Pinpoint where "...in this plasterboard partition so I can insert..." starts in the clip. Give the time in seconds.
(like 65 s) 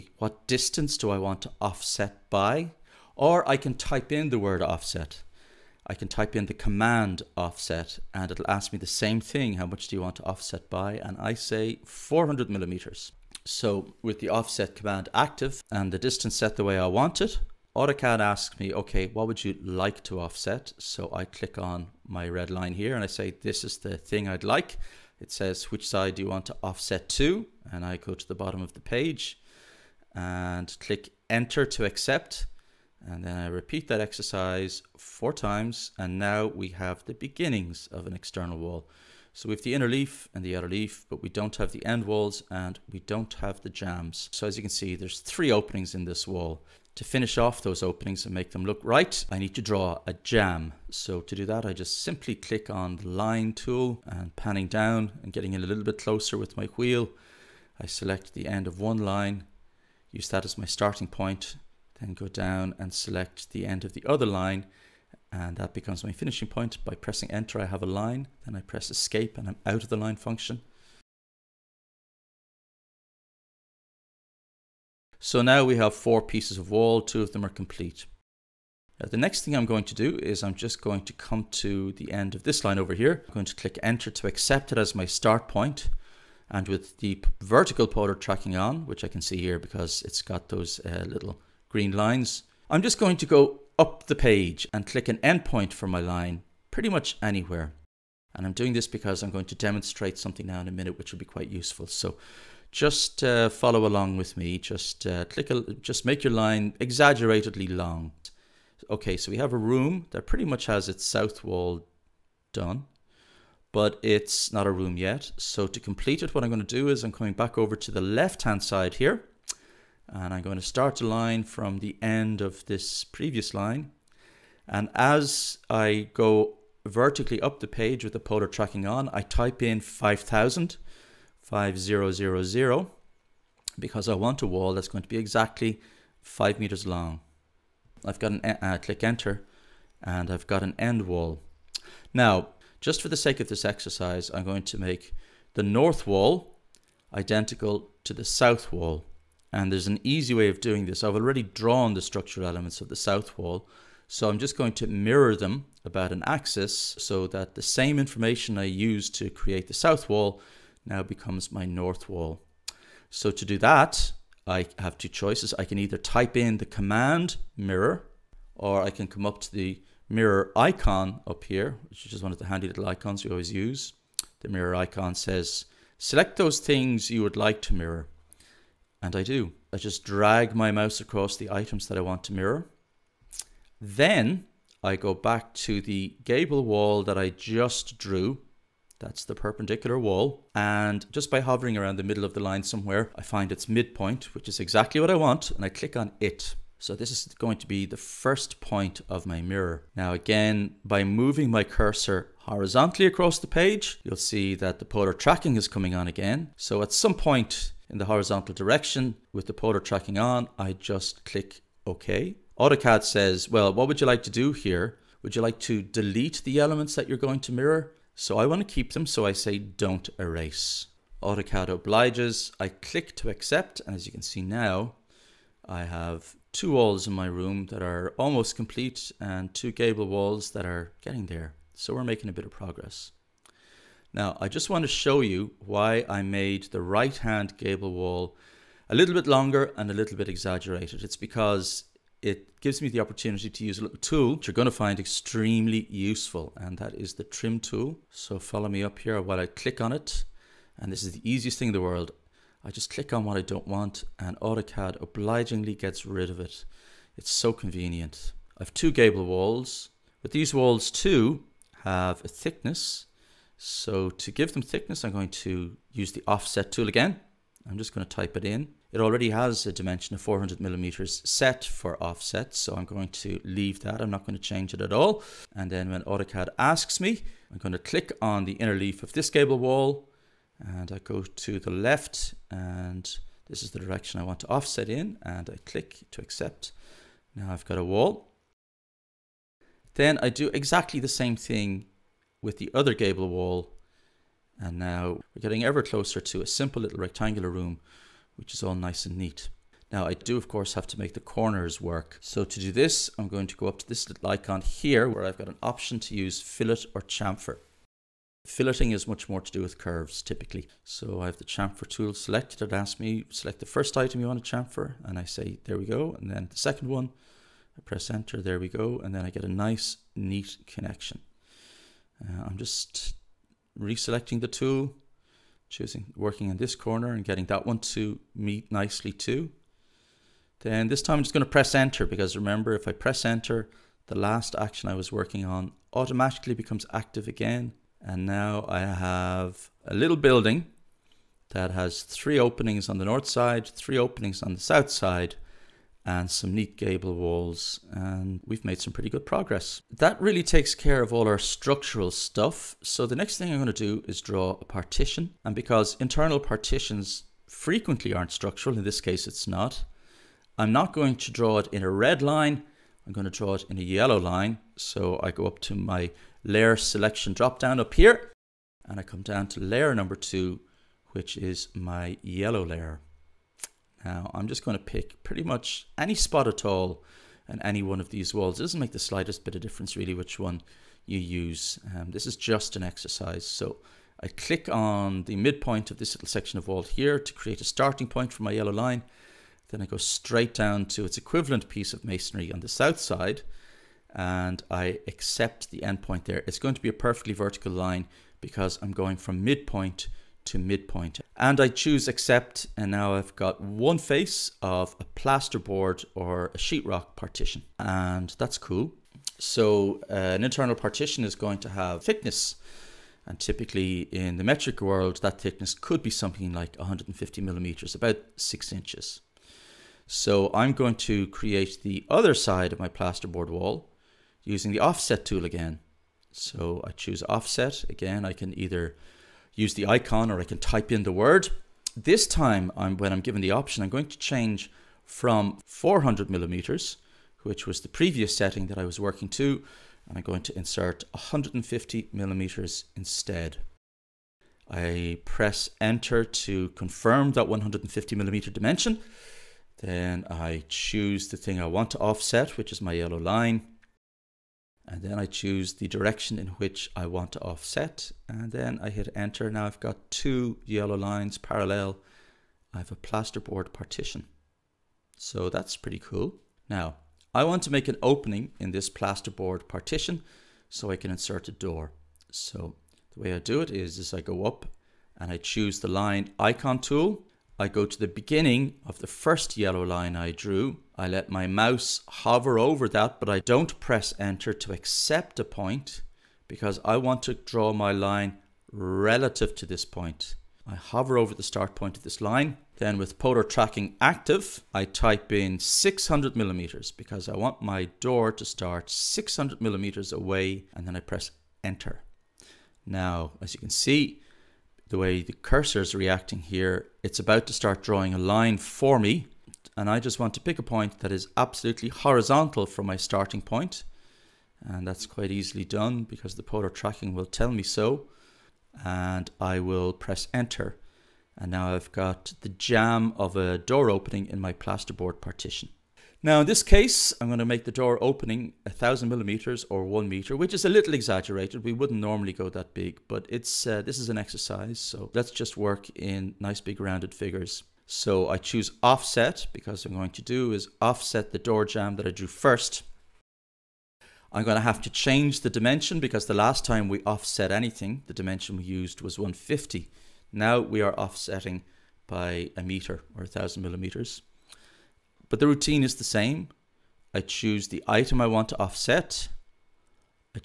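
468 s.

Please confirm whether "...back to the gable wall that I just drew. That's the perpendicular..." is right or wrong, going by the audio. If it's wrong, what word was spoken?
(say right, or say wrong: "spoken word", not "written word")
right.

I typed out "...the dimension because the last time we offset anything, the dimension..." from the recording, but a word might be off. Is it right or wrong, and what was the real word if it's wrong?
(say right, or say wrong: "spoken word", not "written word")
right.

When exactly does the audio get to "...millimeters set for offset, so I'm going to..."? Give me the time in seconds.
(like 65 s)
270 s.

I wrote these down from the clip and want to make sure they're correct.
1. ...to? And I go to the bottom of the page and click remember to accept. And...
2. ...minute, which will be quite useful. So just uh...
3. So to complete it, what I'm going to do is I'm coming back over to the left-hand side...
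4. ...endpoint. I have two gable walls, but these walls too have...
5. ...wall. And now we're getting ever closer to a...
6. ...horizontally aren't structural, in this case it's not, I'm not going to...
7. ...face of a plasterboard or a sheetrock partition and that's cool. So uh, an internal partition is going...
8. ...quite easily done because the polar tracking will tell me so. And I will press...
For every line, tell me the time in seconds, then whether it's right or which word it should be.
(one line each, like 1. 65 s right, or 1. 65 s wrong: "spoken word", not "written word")
1. 27 s wrong: "enter", not "remember"
2. 100 s right
3. 115 s right
4. 257 s wrong: "convenient", not "endpoint"
5. 293 s right
6. 357 s wrong: "frequently", not "horizontally"
7. 403 s right
8. 515 s right.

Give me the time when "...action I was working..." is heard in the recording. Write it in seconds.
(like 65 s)
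334 s.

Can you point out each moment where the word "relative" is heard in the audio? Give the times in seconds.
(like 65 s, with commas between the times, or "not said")
488 s.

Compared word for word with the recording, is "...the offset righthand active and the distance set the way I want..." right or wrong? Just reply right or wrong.
wrong.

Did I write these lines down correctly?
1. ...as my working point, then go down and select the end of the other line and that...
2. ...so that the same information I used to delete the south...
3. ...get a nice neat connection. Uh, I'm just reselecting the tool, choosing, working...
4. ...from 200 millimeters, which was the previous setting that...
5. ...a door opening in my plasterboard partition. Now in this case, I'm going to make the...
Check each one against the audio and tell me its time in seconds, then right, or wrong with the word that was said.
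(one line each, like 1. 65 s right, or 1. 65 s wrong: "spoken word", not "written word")
1. 60 s wrong: "starting", not "working"
2. 156 s wrong: "create", not "delete"
3. 319 s right
4. 435 s wrong: "400", not "200"
5. 523 s right.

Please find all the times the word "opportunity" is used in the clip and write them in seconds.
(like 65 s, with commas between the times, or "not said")
242 s.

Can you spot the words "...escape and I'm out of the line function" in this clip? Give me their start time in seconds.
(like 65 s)
68 s.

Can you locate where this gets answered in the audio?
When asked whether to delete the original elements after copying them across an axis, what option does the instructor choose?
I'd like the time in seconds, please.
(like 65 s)
219 s.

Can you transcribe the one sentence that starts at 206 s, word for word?
So at some point, in the horizontal direction with the polar tracking on, I just click OK.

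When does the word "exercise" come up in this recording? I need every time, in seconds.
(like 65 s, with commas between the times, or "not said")
33 s, 143 s, 382 s, 534 s.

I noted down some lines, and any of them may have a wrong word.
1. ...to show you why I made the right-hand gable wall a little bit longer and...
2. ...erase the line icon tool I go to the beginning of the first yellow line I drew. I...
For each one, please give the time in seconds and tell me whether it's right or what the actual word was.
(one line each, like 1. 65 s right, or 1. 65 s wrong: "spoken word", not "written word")
1. 234 s right
2. 475 s wrong: "choose", not "erase".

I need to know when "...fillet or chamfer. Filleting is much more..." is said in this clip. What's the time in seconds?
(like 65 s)
306 s.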